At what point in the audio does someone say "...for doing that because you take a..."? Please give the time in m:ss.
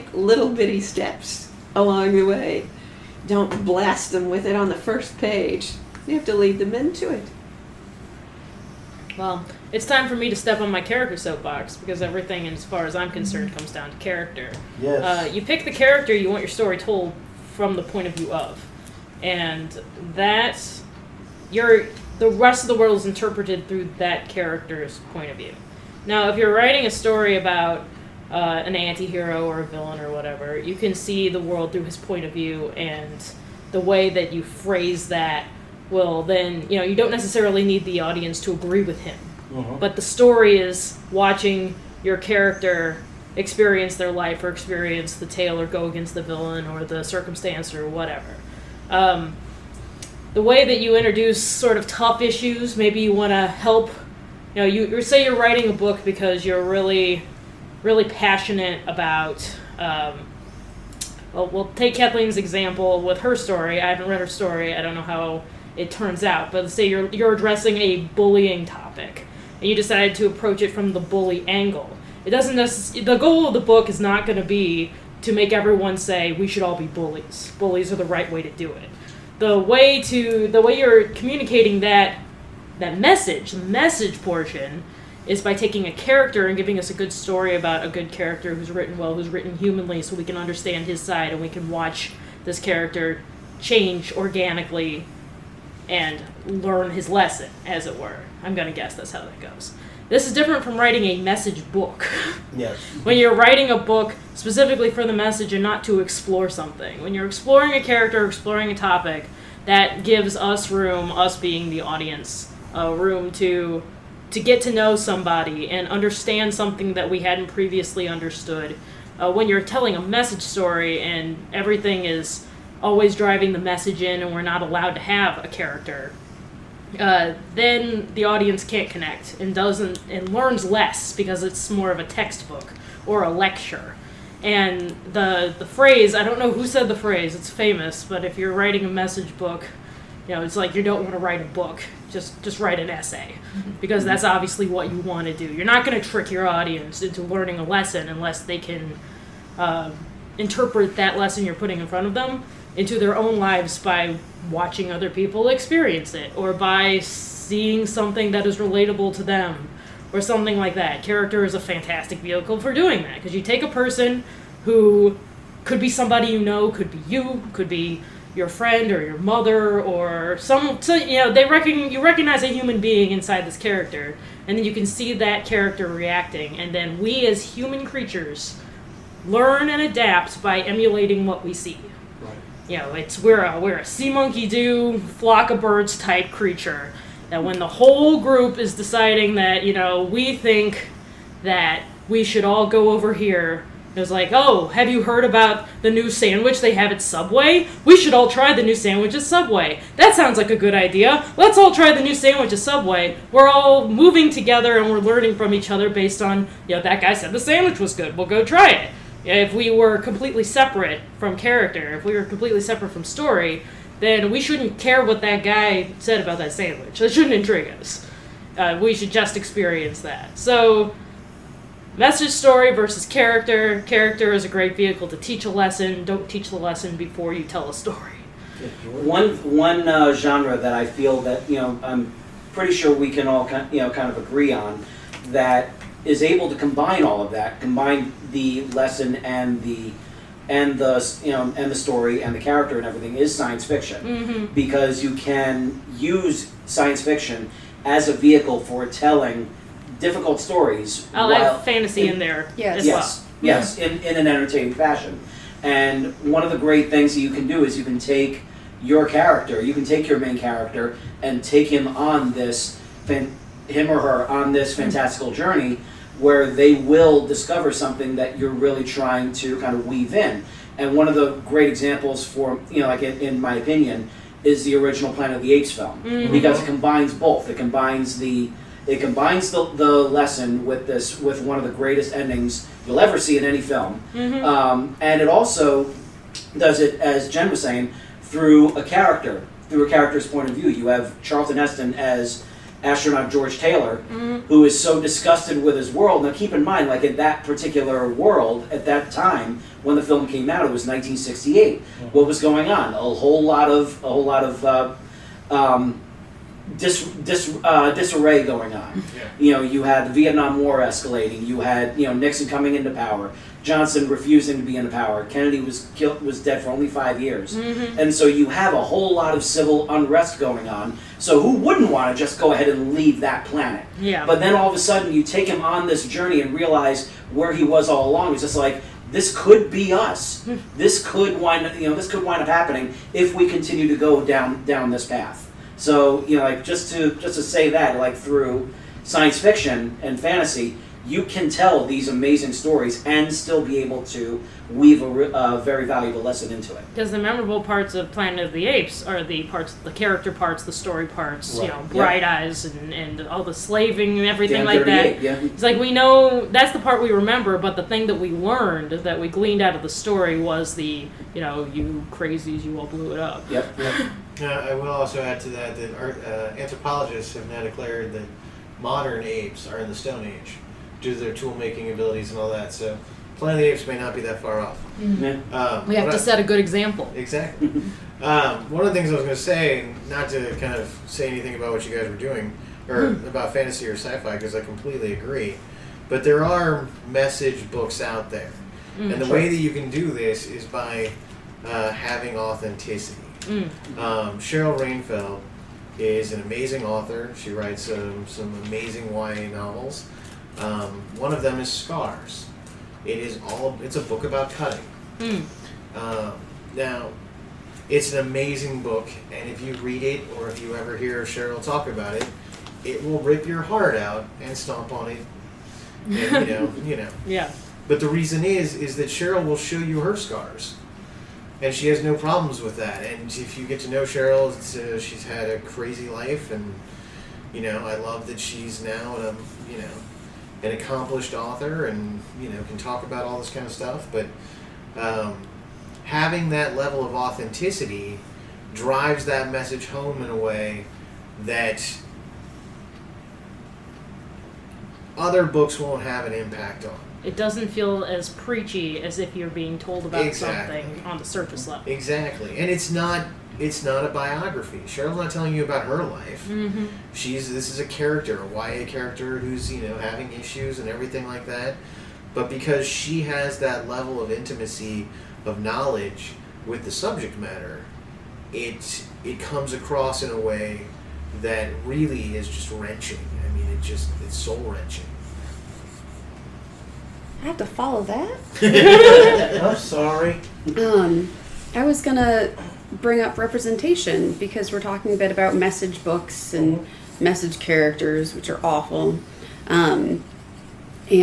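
2:42.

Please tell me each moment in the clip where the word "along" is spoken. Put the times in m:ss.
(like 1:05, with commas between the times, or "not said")
0:01, 5:28.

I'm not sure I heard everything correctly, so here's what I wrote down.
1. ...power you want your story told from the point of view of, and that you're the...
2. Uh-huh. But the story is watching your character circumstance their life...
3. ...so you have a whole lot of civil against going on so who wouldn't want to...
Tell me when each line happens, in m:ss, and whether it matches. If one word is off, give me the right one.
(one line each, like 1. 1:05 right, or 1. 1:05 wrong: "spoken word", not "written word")
1. 0:15 wrong: "character", not "power"
2. 0:39 wrong: "experience", not "circumstance"
3. 5:18 wrong: "unrest", not "against".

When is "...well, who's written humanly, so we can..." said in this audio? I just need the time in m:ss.
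1:28.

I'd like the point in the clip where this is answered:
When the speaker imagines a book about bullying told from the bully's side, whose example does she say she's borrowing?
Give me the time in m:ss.
1:01.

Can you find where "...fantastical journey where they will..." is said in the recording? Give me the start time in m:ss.
4:24.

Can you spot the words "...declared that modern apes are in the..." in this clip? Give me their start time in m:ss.
6:07.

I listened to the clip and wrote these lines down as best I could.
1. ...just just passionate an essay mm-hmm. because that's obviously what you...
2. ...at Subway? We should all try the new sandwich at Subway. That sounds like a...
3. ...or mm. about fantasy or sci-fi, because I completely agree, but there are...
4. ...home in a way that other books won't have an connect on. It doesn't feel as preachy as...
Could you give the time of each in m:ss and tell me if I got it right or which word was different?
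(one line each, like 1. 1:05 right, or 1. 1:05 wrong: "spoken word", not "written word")
1. 2:22 wrong: "write", not "passionate"
2. 3:16 right
3. 6:22 right
4. 7:19 wrong: "impact", not "connect".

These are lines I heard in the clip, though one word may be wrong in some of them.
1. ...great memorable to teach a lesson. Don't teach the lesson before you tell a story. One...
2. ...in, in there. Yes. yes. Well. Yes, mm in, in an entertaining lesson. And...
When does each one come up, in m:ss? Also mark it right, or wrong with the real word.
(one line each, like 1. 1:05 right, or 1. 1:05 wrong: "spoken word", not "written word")
1. 3:44 wrong: "vehicle", not "memorable"
2. 4:12 wrong: "fashion", not "lesson".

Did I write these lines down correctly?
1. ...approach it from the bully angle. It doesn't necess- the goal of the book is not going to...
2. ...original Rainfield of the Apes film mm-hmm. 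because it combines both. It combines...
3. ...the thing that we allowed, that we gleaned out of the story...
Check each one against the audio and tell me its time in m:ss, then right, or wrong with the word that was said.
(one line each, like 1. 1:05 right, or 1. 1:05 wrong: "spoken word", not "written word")
1. 1:10 right
2. 4:34 wrong: "Planet", not "Rainfield"
3. 5:57 wrong: "learned", not "allowed".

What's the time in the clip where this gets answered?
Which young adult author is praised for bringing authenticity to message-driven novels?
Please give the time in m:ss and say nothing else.
6:34.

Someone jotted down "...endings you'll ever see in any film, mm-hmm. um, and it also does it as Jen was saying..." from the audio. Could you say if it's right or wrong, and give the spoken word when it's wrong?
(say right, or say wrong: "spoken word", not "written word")
right.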